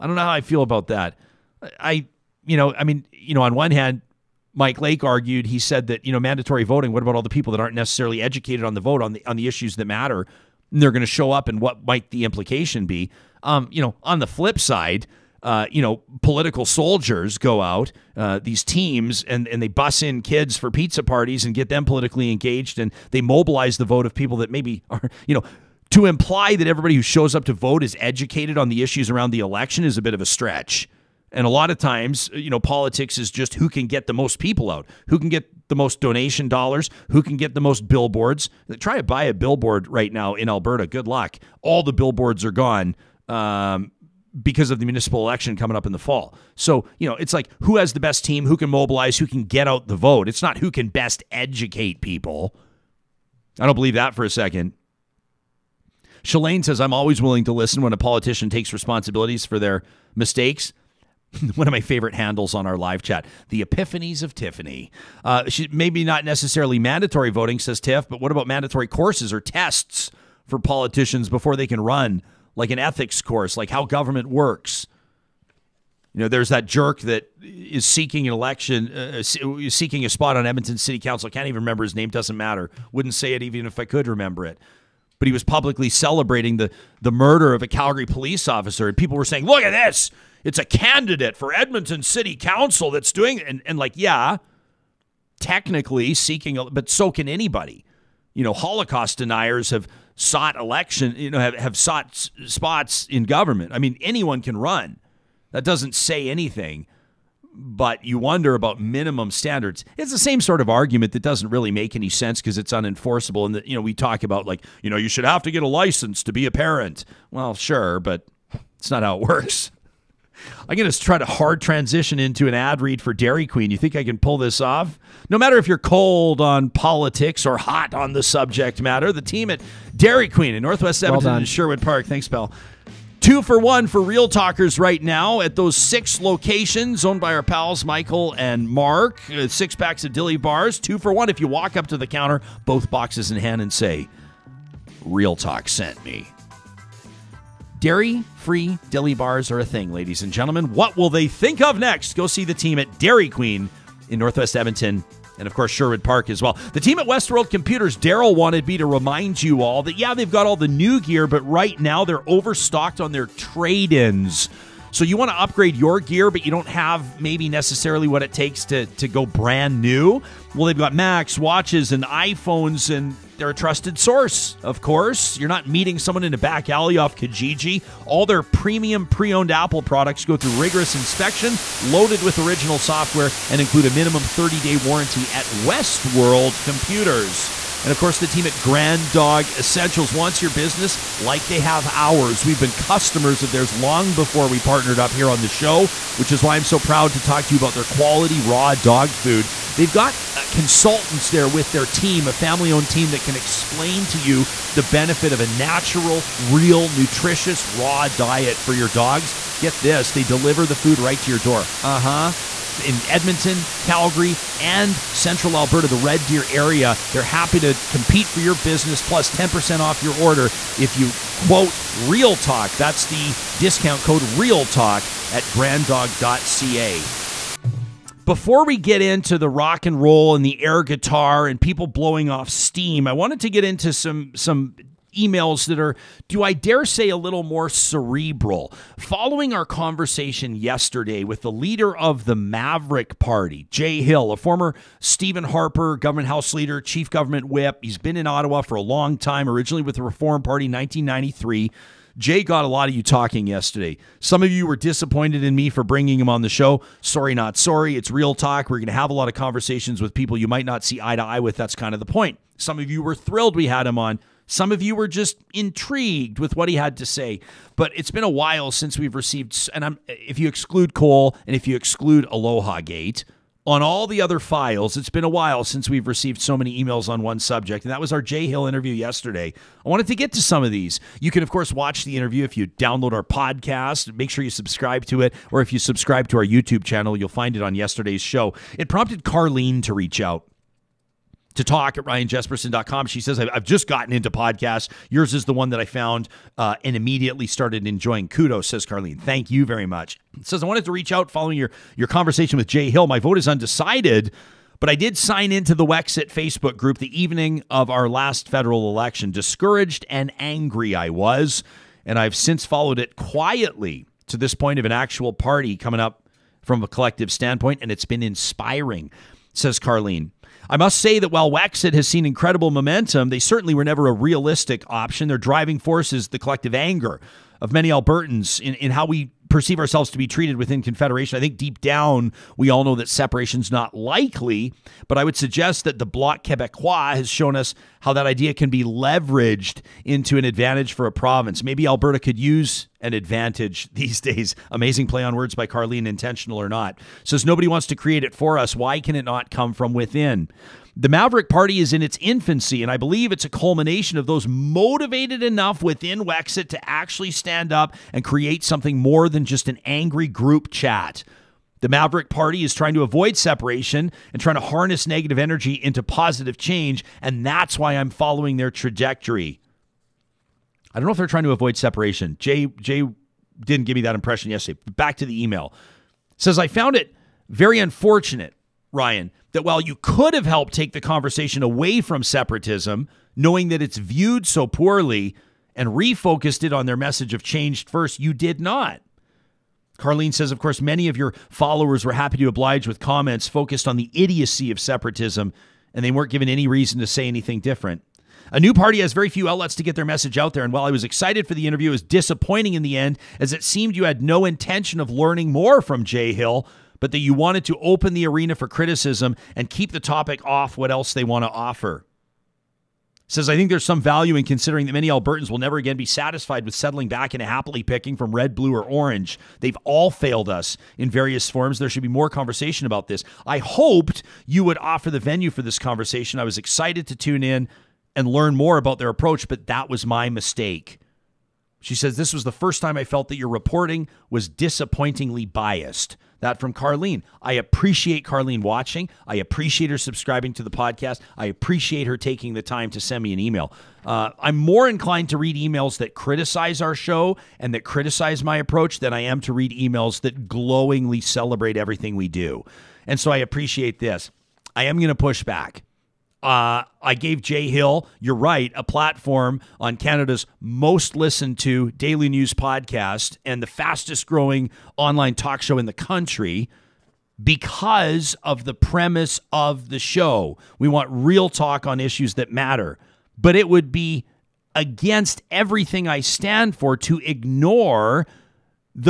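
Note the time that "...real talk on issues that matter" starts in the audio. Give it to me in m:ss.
7:51.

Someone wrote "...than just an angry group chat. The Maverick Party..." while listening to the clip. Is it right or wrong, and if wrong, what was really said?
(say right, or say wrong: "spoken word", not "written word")
right.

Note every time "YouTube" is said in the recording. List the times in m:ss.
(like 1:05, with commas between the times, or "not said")
4:46.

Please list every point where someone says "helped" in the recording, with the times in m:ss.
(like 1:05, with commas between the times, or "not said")
6:20.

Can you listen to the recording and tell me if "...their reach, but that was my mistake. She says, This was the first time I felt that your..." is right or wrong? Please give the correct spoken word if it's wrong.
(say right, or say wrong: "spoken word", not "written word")
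wrong: "approach", not "reach".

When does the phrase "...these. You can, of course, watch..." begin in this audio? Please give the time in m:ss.
4:40.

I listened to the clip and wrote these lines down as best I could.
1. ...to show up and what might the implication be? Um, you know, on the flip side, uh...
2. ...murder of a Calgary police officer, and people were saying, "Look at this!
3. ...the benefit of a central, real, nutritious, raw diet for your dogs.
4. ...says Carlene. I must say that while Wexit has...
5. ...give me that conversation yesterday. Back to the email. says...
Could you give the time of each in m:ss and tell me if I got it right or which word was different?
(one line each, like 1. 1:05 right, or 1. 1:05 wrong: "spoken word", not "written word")
1. 0:11 right
2. 1:27 right
3. 3:24 wrong: "natural", not "central"
4. 5:19 right
5. 6:13 wrong: "impression", not "conversation".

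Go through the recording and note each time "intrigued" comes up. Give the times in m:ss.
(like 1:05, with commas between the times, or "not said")
4:25.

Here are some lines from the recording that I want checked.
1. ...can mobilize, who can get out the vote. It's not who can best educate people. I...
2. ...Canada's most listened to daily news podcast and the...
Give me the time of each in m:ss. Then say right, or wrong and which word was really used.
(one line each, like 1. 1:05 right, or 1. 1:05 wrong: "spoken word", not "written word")
1. 0:48 right
2. 7:39 right.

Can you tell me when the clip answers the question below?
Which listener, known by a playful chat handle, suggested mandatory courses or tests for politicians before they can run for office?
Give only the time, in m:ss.
1:03.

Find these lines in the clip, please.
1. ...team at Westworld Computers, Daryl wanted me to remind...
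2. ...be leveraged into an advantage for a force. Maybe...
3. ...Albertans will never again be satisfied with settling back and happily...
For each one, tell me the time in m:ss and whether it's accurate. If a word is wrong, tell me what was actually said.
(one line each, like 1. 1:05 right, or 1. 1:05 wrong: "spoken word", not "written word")
1. 2:36 right
2. 5:38 wrong: "province", not "force"
3. 6:55 right.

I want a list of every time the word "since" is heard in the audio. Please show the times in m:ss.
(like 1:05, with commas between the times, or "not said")
4:28, 4:35, 5:12.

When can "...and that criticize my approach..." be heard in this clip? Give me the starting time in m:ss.
7:27.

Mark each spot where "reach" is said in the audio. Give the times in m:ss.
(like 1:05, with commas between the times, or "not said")
4:49, 5:00.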